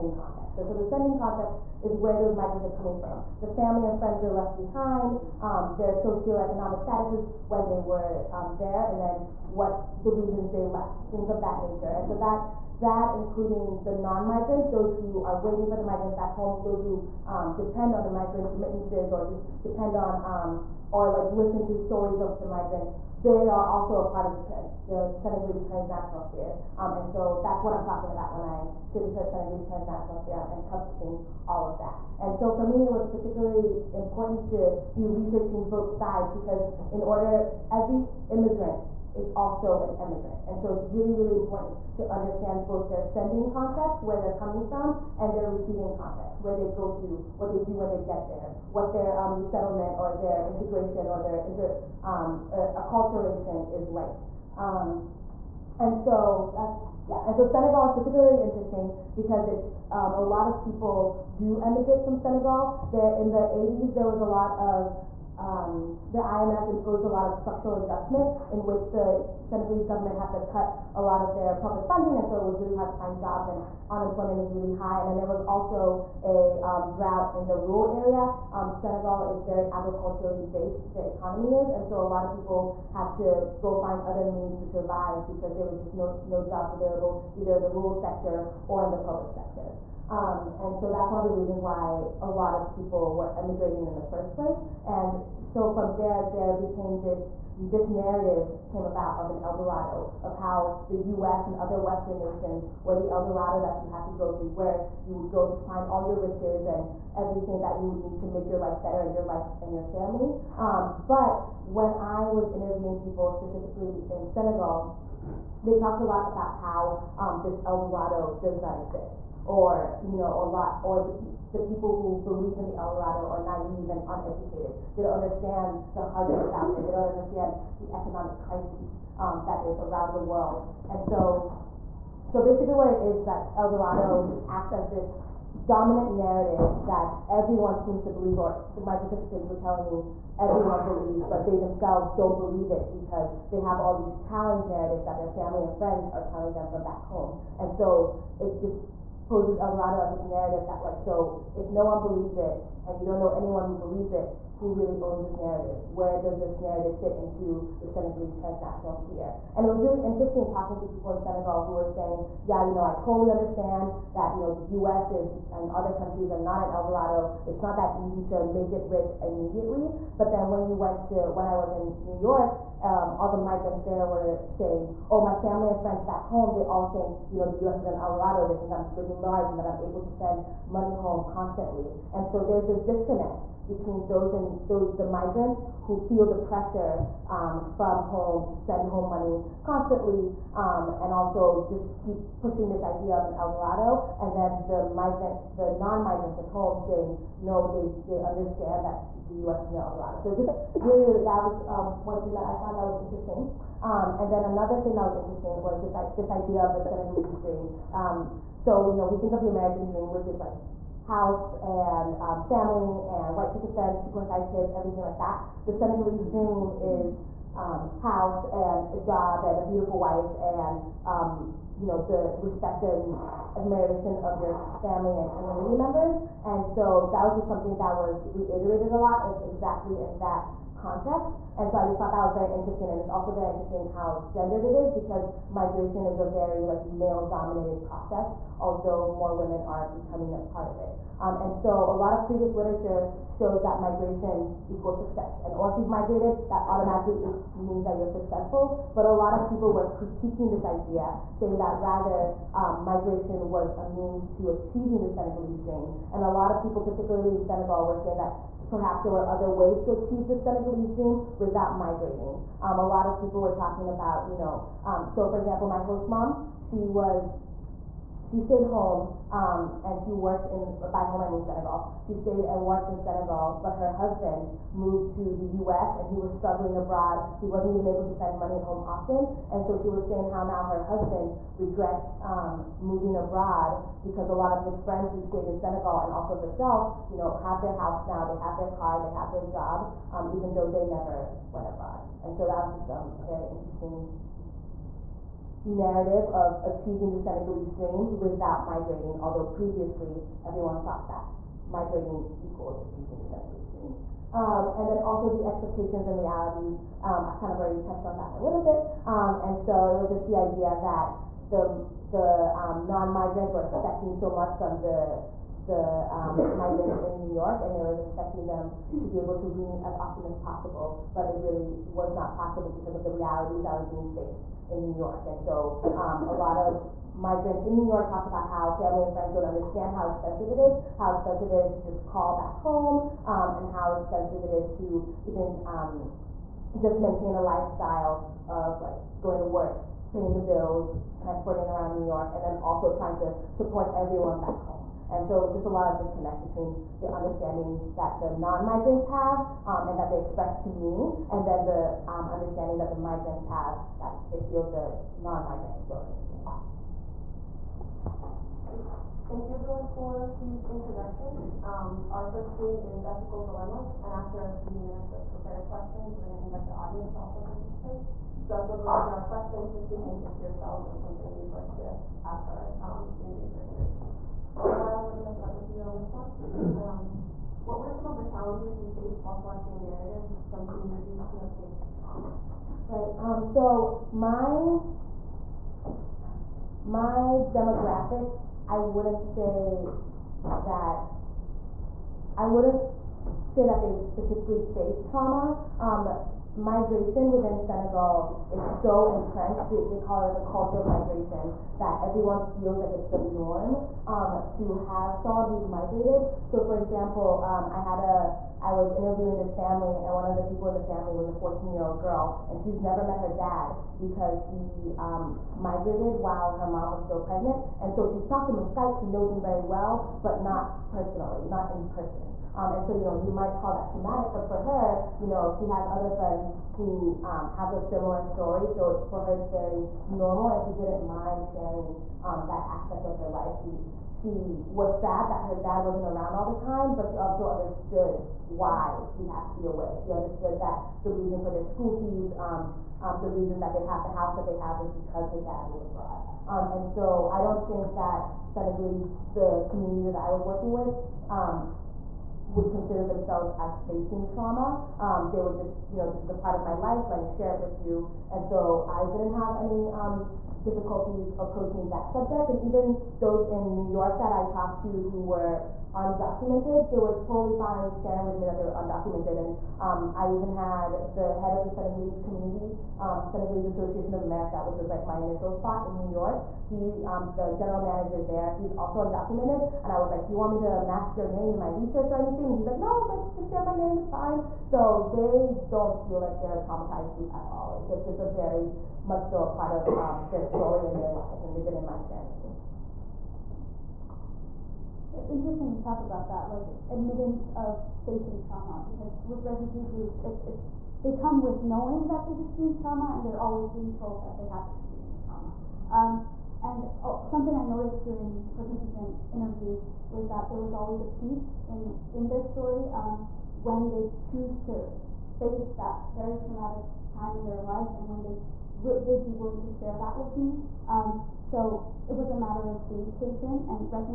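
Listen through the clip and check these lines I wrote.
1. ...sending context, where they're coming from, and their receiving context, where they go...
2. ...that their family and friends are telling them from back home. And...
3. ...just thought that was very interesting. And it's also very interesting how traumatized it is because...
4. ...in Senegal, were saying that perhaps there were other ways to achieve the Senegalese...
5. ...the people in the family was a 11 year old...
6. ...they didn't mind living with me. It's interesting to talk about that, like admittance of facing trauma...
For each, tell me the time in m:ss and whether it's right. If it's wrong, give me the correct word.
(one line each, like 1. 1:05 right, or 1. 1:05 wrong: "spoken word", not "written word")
1. 0:43 right
2. 2:25 right
3. 3:51 wrong: "gendered", not "traumatized"
4. 4:17 right
5. 6:50 wrong: "14", not "11"
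6. 8:11 wrong: "sharing", not "living".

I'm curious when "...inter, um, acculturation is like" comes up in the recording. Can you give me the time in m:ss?
0:51.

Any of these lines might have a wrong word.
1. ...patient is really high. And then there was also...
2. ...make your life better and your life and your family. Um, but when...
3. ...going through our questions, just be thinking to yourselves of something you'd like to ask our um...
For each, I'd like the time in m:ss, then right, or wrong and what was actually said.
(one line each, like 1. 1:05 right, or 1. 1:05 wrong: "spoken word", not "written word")
1. 1:13 wrong: "unemployment", not "patient"
2. 1:48 right
3. 6:08 right.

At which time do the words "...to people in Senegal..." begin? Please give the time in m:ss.
2:40.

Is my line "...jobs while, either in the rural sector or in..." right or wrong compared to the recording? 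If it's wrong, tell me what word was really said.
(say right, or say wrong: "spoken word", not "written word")
wrong: "available", not "while".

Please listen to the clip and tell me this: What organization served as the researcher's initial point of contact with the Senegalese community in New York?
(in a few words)
Senegalese Association of America.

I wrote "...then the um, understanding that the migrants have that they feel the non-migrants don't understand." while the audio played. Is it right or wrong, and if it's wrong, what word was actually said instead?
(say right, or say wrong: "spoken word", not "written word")
right.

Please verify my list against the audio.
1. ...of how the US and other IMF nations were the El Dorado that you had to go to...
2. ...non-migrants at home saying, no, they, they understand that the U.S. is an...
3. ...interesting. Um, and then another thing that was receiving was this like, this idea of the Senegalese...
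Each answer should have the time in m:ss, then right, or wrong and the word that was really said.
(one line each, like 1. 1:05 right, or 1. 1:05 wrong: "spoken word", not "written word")
1. 1:40 wrong: "Western", not "IMF"
2. 3:15 right
3. 3:23 wrong: "interesting", not "receiving".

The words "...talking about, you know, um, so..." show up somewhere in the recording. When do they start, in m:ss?
4:23.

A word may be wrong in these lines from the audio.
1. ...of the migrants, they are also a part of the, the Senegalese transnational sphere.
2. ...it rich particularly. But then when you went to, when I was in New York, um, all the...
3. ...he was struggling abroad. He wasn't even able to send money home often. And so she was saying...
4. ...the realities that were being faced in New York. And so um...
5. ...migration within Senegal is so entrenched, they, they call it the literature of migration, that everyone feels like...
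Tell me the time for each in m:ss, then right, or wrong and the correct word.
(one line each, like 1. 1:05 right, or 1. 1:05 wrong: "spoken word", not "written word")
1. 0:22 right
2. 2:48 wrong: "immediately", not "particularly"
3. 4:36 right
4. 5:23 right
5. 6:36 wrong: "culture", not "literature".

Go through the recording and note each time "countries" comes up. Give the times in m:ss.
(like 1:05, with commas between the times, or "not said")
2:45.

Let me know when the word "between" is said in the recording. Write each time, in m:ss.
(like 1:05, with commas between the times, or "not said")
3:03, 5:46.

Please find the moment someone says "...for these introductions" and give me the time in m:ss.
5:59.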